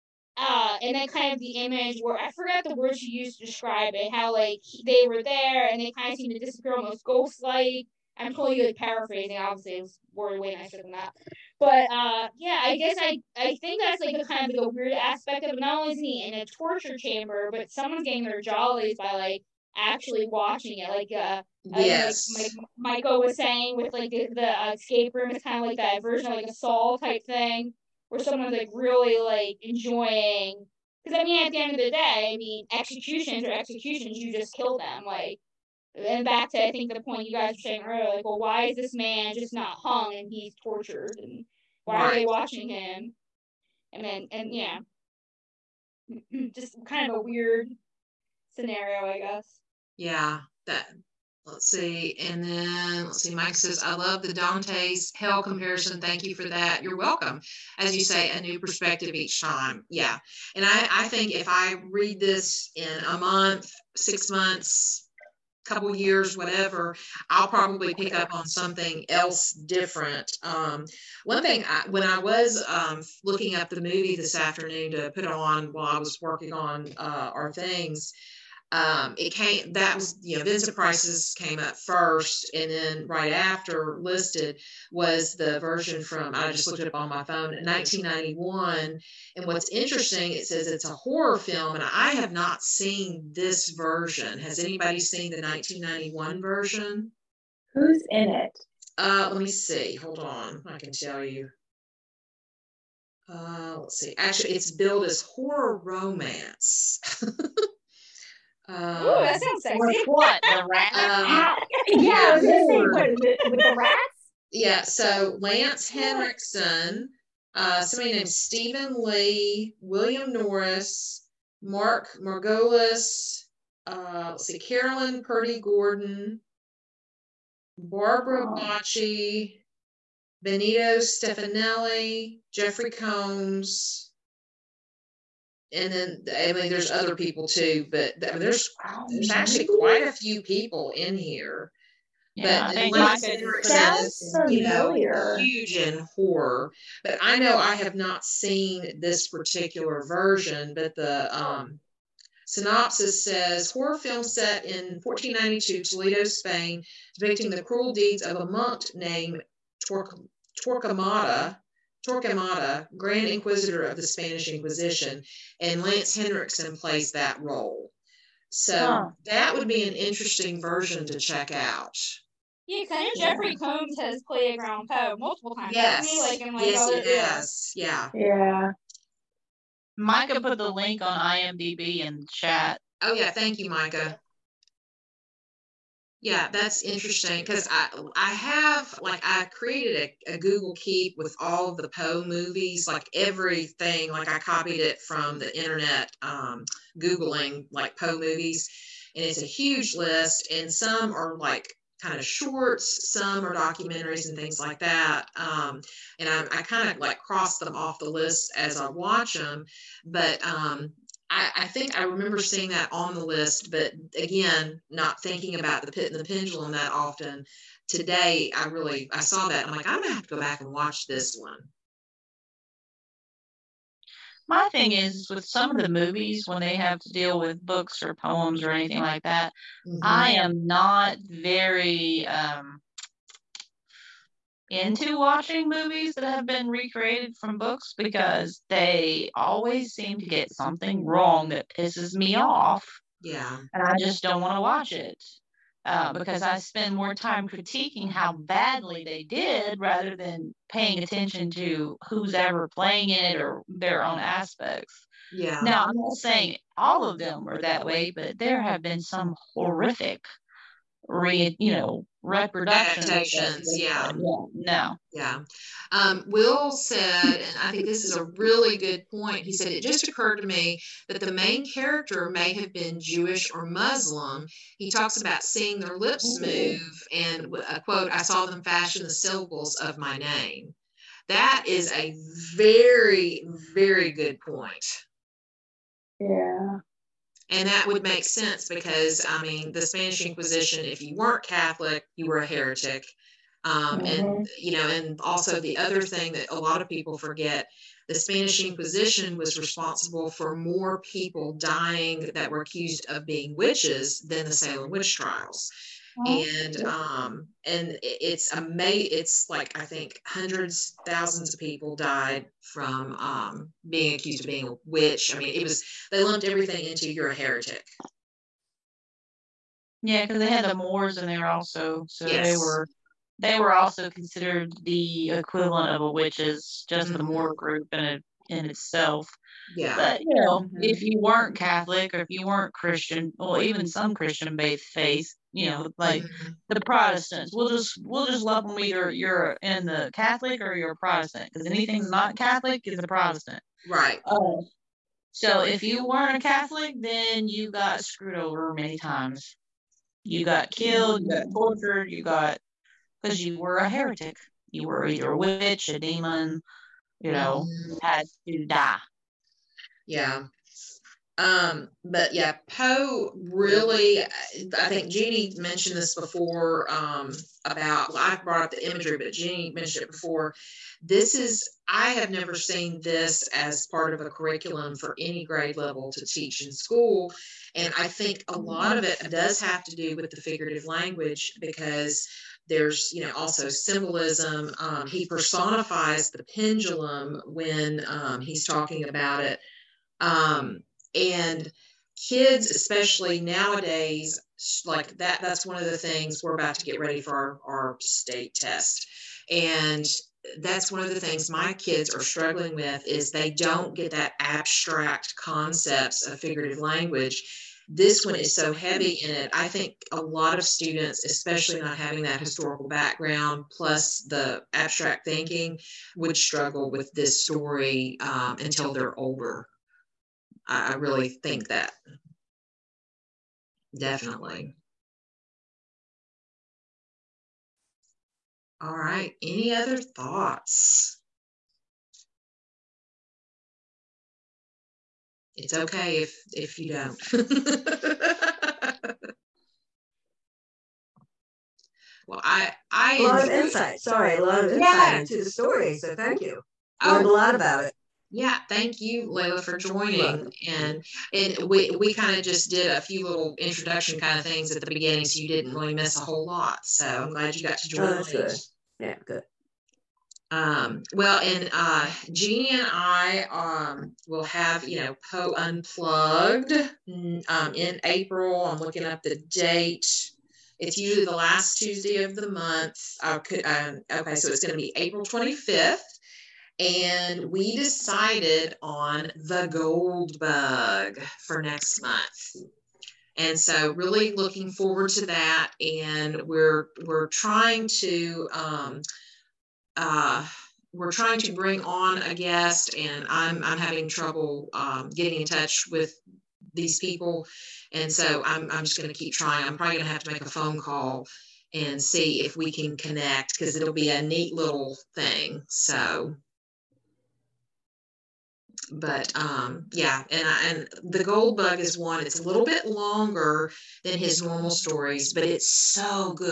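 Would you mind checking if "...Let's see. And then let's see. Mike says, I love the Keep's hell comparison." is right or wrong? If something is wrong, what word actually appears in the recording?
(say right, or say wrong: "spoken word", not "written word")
wrong: "Dante", not "Keep".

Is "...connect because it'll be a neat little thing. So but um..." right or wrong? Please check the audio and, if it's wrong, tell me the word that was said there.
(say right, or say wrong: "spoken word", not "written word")
right.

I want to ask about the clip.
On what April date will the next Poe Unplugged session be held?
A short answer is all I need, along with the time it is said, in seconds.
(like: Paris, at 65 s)
April 25th, at 474 s.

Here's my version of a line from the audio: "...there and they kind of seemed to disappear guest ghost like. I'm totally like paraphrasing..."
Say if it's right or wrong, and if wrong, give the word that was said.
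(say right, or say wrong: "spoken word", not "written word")
wrong: "almost", not "guest".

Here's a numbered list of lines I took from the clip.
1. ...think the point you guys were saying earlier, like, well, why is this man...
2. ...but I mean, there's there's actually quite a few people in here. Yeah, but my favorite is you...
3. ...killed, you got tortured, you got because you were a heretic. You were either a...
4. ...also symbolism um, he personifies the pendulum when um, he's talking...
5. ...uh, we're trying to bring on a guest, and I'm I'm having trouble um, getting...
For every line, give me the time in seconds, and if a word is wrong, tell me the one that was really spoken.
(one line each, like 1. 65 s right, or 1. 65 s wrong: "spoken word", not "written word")
1. 36 s right
2. 137 s right
3. 350 s right
4. 383 s right
5. 489 s right.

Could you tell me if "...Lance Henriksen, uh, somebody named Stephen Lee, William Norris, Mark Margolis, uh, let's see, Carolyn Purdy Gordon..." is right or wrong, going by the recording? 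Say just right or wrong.
right.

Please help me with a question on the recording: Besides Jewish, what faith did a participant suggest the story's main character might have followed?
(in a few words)
Muslim.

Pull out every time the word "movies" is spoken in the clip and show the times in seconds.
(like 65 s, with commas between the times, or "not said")
73 s, 192 s, 198 s, 225 s, 235 s.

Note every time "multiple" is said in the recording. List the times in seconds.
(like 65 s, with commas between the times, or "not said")
175 s.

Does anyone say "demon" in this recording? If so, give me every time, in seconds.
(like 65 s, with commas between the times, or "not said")
355 s.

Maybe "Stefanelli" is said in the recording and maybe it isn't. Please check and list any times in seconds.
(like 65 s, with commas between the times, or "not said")
130 s.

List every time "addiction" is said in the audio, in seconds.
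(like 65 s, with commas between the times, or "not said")
not said.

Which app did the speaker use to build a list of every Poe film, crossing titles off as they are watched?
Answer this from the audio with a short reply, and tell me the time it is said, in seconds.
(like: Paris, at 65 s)
Google Keep, at 190 s.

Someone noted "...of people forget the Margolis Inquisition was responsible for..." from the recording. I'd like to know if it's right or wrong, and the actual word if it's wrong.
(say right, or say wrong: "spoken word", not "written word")
wrong: "Spanish", not "Margolis".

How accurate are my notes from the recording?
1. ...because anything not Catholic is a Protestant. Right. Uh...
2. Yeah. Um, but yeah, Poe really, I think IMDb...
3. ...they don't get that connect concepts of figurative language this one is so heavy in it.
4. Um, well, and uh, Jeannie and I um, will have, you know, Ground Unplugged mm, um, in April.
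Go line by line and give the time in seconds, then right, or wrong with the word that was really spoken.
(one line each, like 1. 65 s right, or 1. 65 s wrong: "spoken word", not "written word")
1. 341 s right
2. 360 s wrong: "Jeannie", not "IMDb"
3. 403 s wrong: "abstract", not "connect"
4. 460 s wrong: "Poe", not "Ground".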